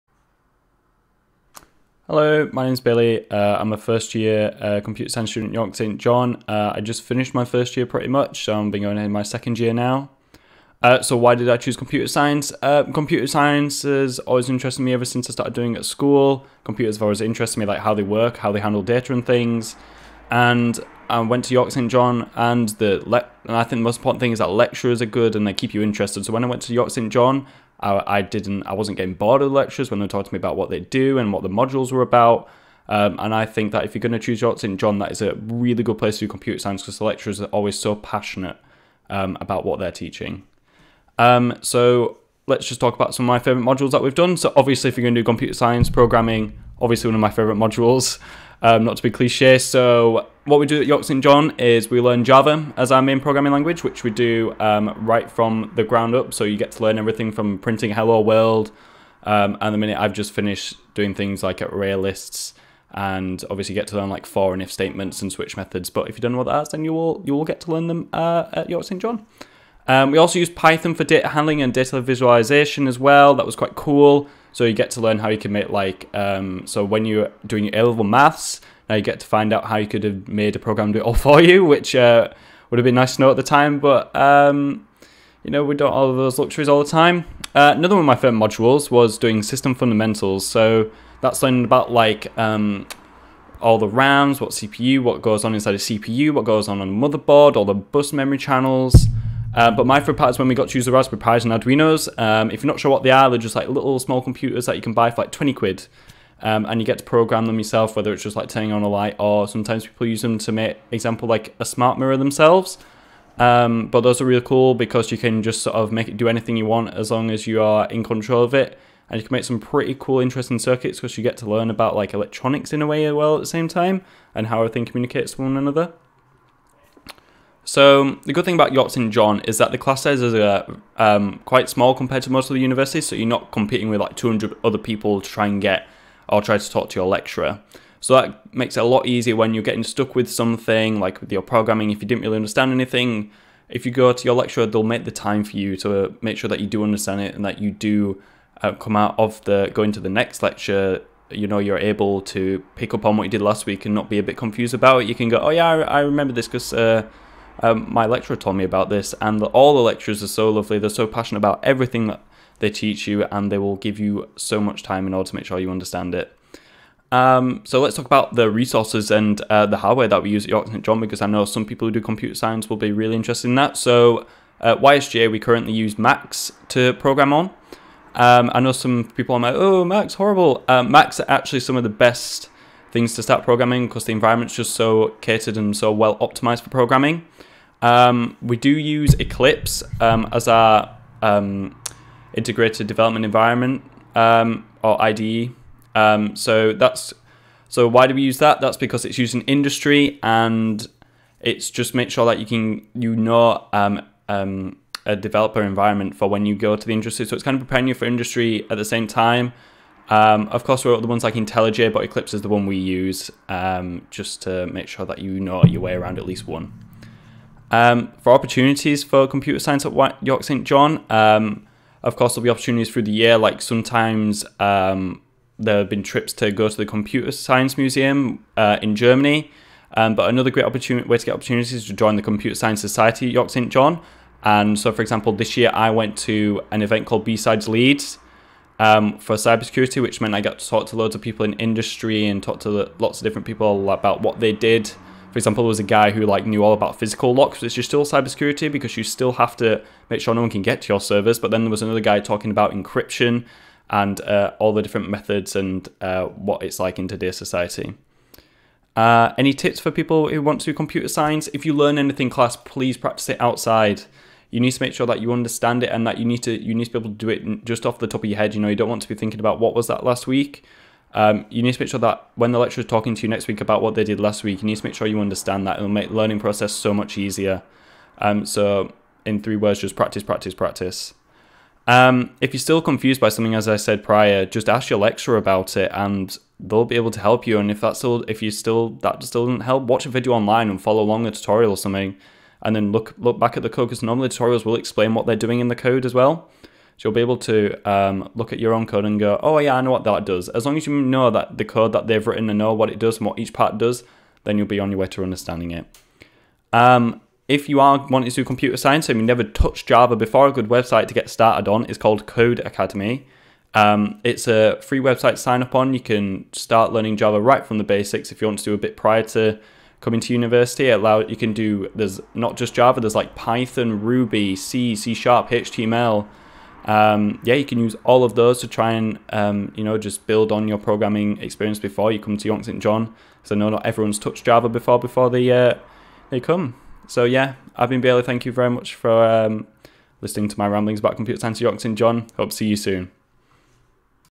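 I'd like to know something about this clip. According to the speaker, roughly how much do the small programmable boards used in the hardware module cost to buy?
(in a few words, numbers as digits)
20 quid.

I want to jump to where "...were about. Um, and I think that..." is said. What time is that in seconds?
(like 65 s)
31 s.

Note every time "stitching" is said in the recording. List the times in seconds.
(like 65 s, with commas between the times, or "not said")
not said.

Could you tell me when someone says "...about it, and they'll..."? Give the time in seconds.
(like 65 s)
285 s.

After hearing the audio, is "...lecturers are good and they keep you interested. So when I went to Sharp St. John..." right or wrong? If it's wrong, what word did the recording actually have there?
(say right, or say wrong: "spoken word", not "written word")
wrong: "York", not "Sharp".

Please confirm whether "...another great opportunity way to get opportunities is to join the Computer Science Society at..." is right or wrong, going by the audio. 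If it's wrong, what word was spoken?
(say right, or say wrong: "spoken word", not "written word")
right.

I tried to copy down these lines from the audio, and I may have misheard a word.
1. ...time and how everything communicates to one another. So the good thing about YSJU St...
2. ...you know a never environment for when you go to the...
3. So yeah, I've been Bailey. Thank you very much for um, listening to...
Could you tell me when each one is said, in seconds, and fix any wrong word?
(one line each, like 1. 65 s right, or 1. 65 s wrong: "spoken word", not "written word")
1. 123 s wrong: "York", not "YSJU"
2. 202 s wrong: "developer", not "never"
3. 337 s right.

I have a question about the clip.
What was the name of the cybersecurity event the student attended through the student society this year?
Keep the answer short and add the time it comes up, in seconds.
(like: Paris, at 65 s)
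B-Sides Leeds, at 237 s.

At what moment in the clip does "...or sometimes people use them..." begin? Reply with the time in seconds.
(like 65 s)
109 s.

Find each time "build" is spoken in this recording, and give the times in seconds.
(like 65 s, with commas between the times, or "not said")
330 s.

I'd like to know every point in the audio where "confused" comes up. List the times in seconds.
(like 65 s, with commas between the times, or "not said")
154 s, 282 s.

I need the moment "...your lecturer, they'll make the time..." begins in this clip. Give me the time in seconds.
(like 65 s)
144 s.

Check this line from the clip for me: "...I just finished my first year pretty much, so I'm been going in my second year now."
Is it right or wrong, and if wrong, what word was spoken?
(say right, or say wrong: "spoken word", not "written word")
right.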